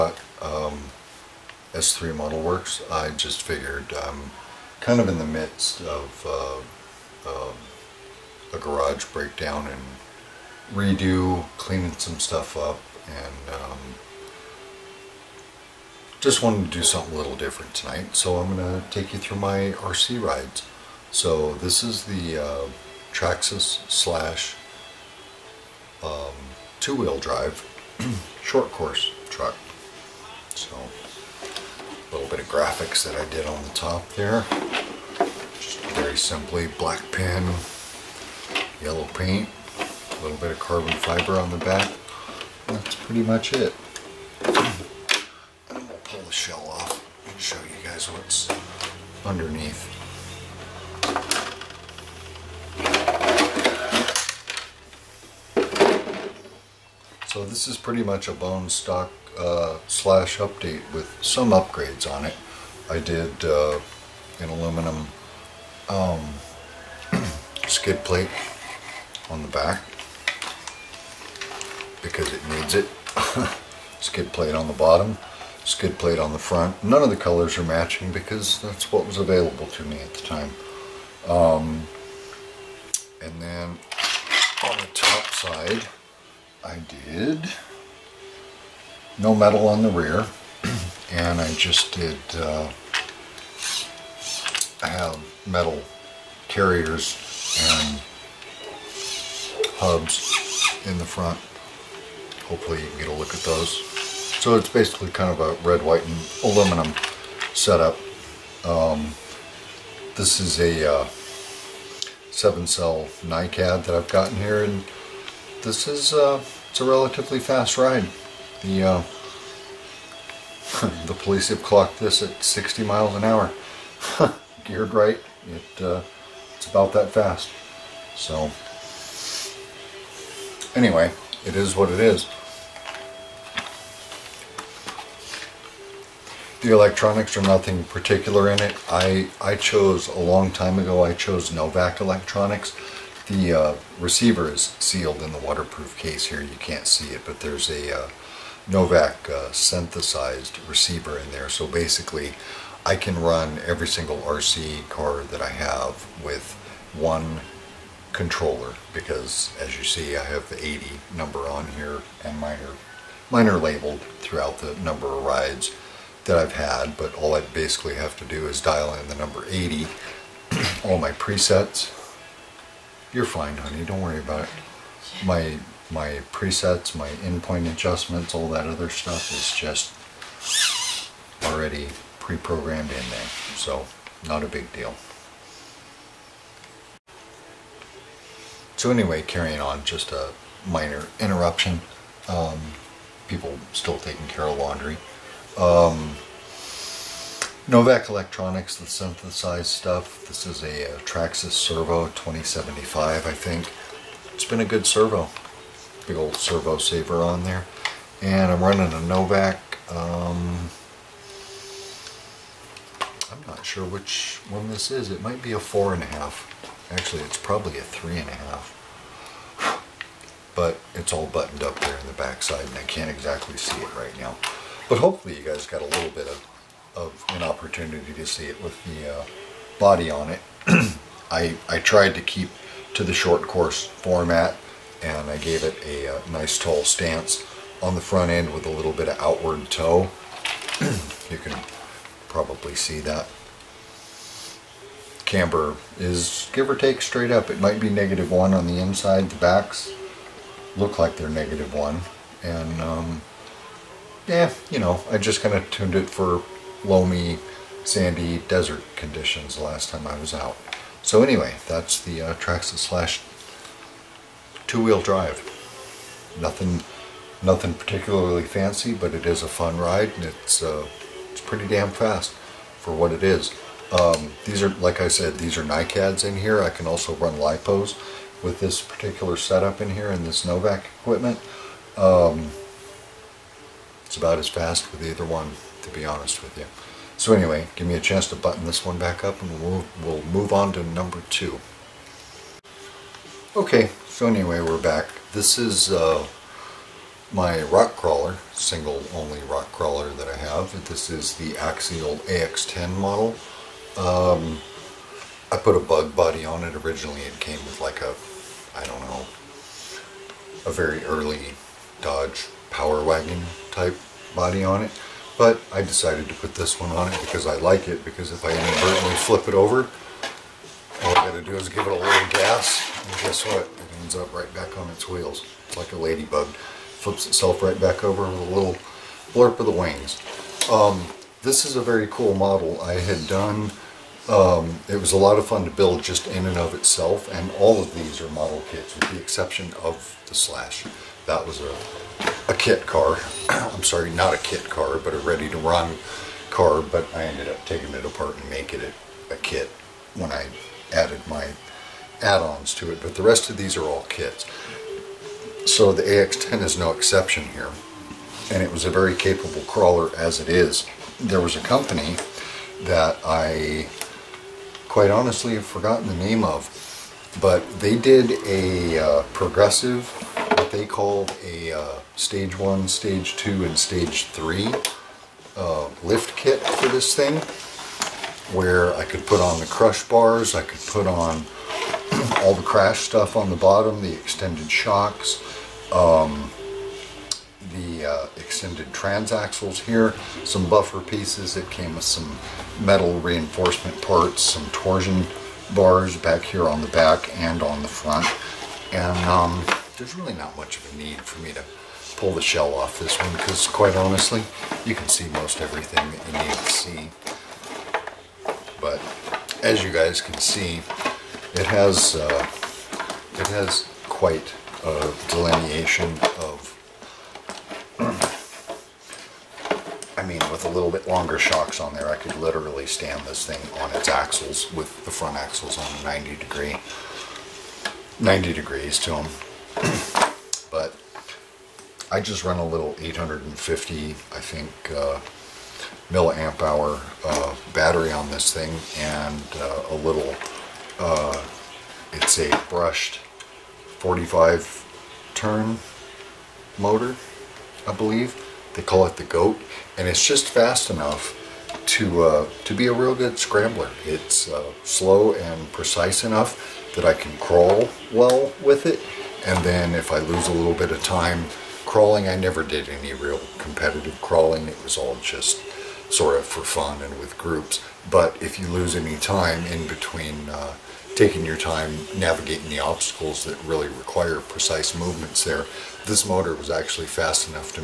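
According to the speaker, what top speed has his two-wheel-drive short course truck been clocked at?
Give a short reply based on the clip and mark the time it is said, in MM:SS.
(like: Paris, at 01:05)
60 miles an hour, at 02:02.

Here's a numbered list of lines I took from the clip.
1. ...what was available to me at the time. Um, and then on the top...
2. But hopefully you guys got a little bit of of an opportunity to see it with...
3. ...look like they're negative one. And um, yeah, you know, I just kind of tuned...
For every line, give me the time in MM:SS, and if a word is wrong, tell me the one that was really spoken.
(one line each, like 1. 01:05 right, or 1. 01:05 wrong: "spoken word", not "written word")
1. 01:18 right
2. 03:44 right
3. 04:10 right.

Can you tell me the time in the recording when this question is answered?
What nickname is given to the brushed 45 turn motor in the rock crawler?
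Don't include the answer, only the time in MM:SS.
07:29.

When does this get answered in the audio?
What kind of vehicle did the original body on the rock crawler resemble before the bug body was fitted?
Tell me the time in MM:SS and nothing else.
05:12.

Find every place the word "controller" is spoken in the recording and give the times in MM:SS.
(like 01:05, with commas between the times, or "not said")
02:38.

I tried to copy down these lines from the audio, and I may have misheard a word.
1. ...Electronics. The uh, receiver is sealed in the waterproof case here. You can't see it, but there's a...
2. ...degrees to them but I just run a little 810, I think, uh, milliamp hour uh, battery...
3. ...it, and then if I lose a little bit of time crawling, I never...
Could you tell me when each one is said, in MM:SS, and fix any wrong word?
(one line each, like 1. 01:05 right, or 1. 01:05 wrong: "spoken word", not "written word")
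1. 02:21 right
2. 07:08 wrong: "850", not "810"
3. 07:38 right.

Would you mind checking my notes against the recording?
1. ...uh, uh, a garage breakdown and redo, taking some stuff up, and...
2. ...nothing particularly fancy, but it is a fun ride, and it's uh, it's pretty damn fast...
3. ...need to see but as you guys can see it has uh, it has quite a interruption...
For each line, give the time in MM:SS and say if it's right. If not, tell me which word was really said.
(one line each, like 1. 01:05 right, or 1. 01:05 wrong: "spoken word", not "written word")
1. 00:06 wrong: "cleaning", not "taking"
2. 04:27 right
3. 06:46 wrong: "delineation", not "interruption".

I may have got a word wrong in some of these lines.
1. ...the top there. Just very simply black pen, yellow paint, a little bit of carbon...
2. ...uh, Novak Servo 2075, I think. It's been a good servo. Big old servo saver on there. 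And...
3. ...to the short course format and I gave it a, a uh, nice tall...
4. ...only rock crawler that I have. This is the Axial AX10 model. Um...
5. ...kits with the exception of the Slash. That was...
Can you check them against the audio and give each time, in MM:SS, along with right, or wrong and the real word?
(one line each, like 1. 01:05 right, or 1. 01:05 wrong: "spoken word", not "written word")
1. 00:33 right
2. 03:20 wrong: "Traxxas", not "Novak"
3. 03:52 right
4. 04:59 right
5. 05:38 right.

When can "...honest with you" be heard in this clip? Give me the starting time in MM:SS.
04:46.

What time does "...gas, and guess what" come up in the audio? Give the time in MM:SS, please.
05:22.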